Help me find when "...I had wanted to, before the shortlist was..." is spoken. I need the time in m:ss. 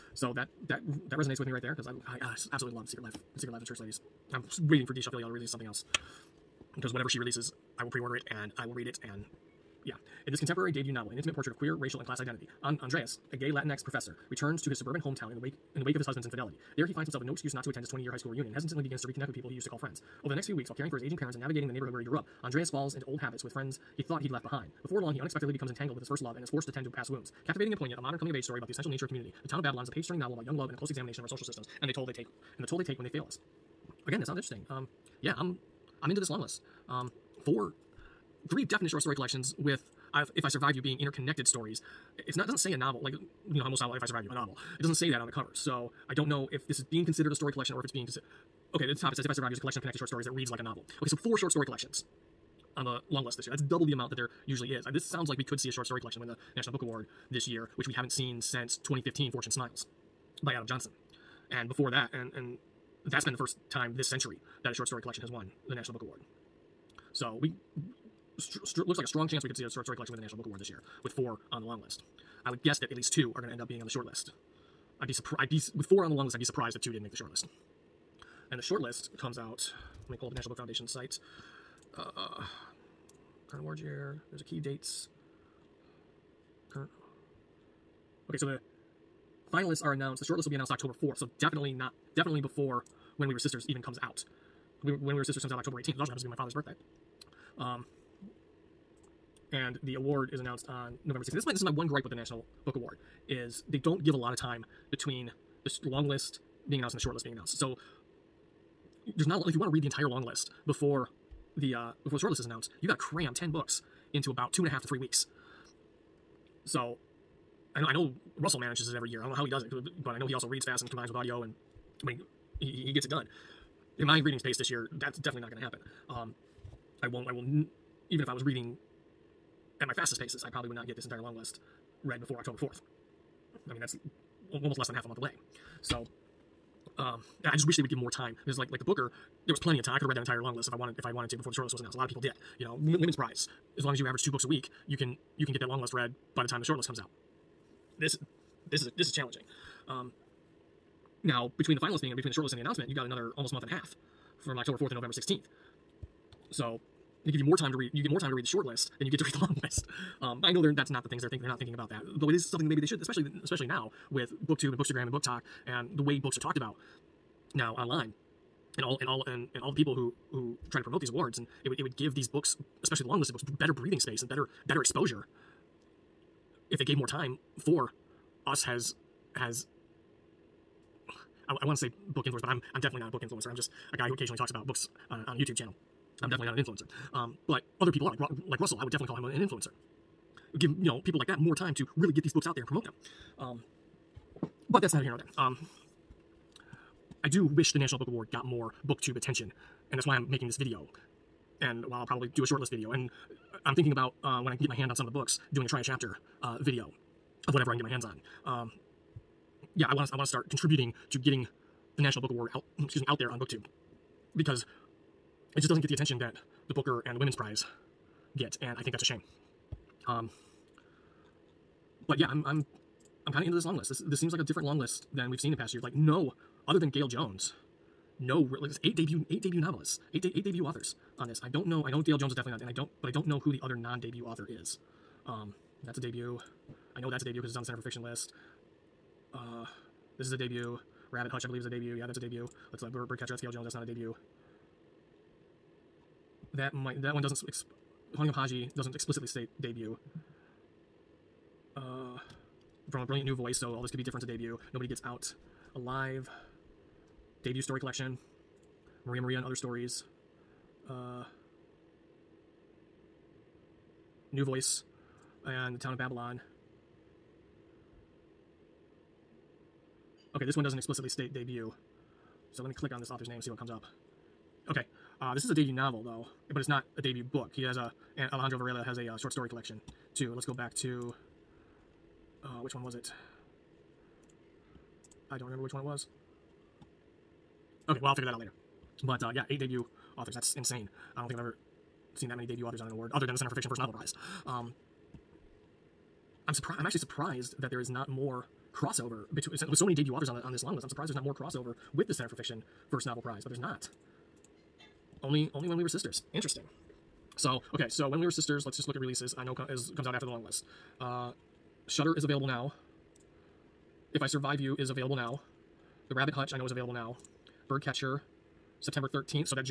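2:21.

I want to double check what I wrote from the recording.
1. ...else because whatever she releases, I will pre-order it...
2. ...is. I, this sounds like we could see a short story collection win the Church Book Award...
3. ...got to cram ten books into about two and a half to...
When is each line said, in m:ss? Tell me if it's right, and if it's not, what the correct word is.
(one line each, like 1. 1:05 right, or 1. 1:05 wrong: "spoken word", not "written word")
1. 0:05 right
2. 0:54 wrong: "National", not "Church"
3. 1:52 right.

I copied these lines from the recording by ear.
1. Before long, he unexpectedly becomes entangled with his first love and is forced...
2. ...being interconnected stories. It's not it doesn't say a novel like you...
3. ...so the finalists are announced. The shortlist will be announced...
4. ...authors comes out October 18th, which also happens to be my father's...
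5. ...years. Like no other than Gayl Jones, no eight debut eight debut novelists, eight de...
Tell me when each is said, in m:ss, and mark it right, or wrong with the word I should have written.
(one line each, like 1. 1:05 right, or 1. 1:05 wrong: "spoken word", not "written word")
1. 0:24 right
2. 0:40 right
3. 1:28 right
4. 1:35 wrong: "sisters", not "authors"
5. 3:45 right.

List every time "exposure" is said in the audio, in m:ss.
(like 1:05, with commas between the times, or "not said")
2:54.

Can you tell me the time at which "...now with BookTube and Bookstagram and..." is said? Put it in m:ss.
2:43.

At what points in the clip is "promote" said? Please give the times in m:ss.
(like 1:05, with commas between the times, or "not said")
2:50, 3:12.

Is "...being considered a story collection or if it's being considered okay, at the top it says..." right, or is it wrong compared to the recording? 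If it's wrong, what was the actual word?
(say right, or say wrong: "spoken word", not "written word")
right.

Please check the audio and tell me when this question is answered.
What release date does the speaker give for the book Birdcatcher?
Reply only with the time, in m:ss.
5:18.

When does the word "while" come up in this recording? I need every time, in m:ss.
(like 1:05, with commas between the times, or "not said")
0:20, 3:21.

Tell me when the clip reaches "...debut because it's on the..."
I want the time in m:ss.
3:57.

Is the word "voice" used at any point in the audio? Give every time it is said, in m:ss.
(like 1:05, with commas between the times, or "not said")
4:13, 4:24.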